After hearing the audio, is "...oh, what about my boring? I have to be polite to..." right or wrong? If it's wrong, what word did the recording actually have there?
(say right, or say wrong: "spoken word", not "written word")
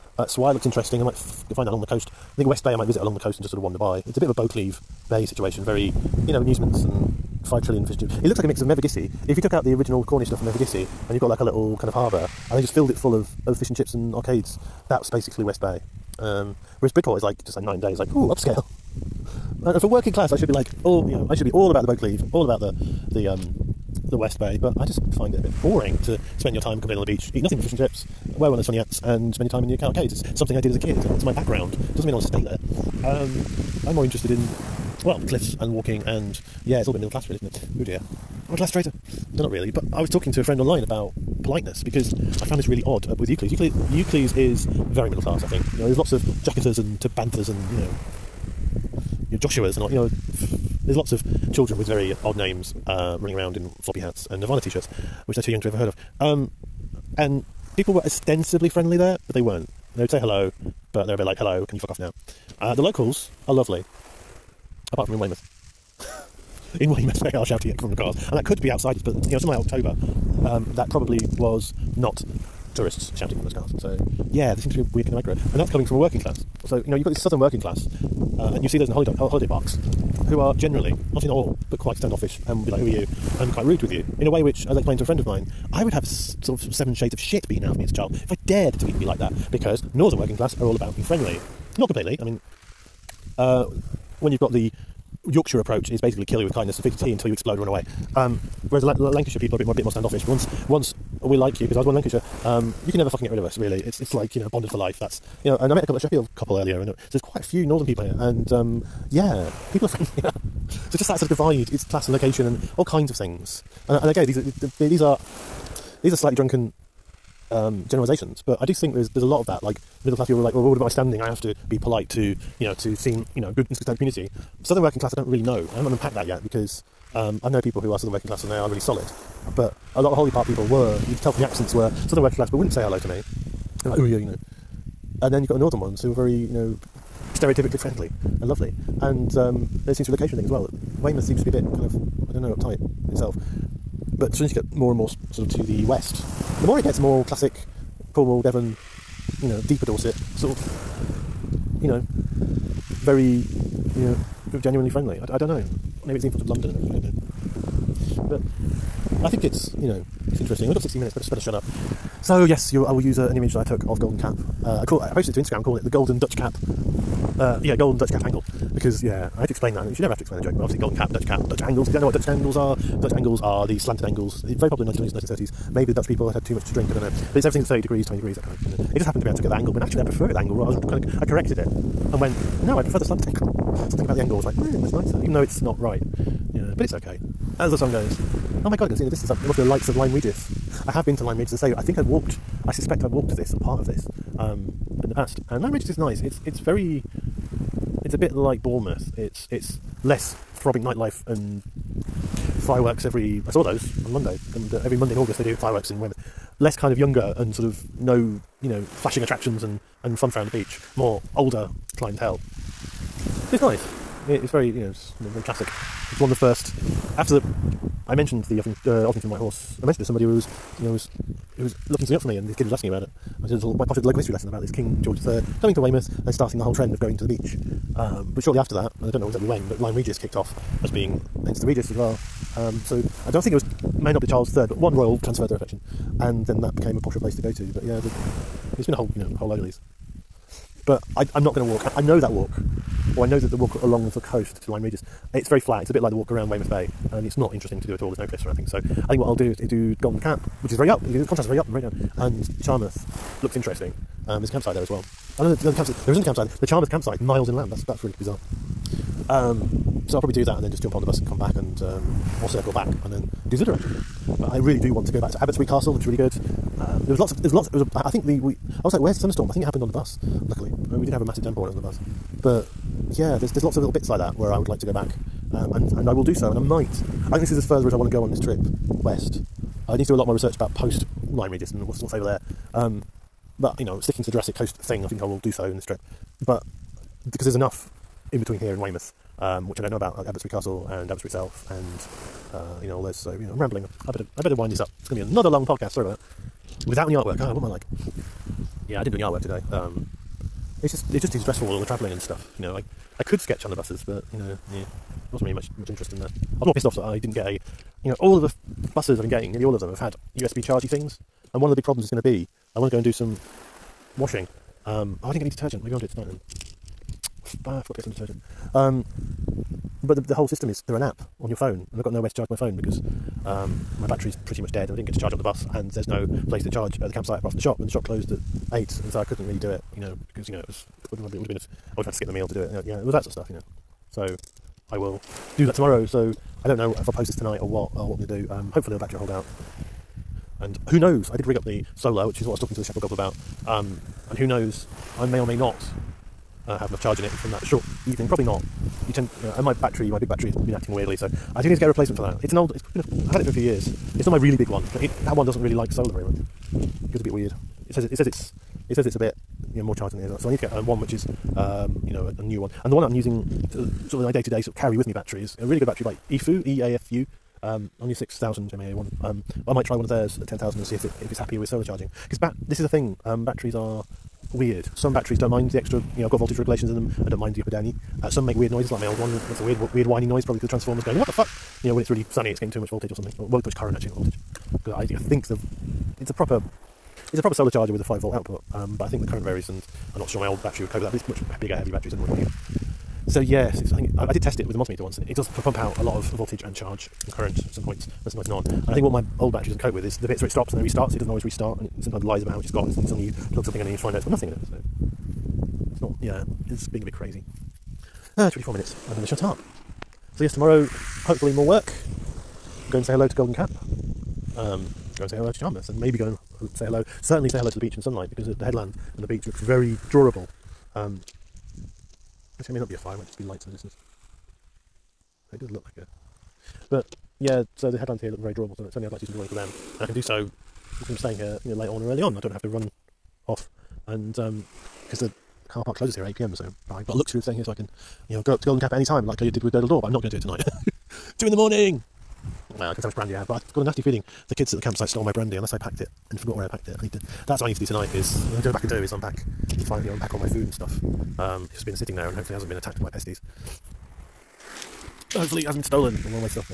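wrong: "standing", not "boring".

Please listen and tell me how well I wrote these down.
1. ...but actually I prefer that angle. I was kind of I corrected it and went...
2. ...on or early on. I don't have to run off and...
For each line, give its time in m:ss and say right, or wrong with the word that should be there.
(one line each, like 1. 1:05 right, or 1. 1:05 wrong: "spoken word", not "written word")
1. 2:59 right
2. 7:11 right.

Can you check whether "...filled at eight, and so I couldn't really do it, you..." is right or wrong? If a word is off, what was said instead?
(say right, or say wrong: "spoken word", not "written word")
wrong: "closed", not "filled".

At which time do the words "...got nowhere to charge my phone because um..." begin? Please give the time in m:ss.
5:22.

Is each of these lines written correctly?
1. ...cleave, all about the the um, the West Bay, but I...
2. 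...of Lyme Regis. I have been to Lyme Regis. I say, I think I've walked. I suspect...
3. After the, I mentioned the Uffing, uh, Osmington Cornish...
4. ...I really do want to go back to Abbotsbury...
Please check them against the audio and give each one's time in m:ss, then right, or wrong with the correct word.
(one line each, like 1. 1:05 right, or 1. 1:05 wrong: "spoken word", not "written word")
1. 0:21 right
2. 3:09 right
3. 3:37 wrong: "White", not "Cornish"
4. 4:24 right.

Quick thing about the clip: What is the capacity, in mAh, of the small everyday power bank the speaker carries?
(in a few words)
6000.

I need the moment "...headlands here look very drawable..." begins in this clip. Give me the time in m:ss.
7:07.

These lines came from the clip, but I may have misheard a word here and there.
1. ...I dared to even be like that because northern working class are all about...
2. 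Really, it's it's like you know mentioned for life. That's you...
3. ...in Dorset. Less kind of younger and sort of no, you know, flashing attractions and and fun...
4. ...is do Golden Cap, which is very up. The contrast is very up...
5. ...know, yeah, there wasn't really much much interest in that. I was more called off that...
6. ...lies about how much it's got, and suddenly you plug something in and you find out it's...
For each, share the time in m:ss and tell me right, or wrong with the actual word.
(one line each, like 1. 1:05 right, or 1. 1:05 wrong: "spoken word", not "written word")
1. 1:28 right
2. 1:43 wrong: "bonded", not "mentioned"
3. 3:25 wrong: "Weymouth", not "Dorset"
4. 4:09 right
5. 5:04 wrong: "pissed", not "called"
6. 6:42 right.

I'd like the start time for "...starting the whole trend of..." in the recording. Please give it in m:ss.
3:46.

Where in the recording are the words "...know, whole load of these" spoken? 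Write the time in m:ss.
3:59.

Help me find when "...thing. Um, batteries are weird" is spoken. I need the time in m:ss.
6:12.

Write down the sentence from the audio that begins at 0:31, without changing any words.
It doesn't mean I want to stay there.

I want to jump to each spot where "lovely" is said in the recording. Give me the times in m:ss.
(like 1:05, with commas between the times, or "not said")
1:03, 2:18.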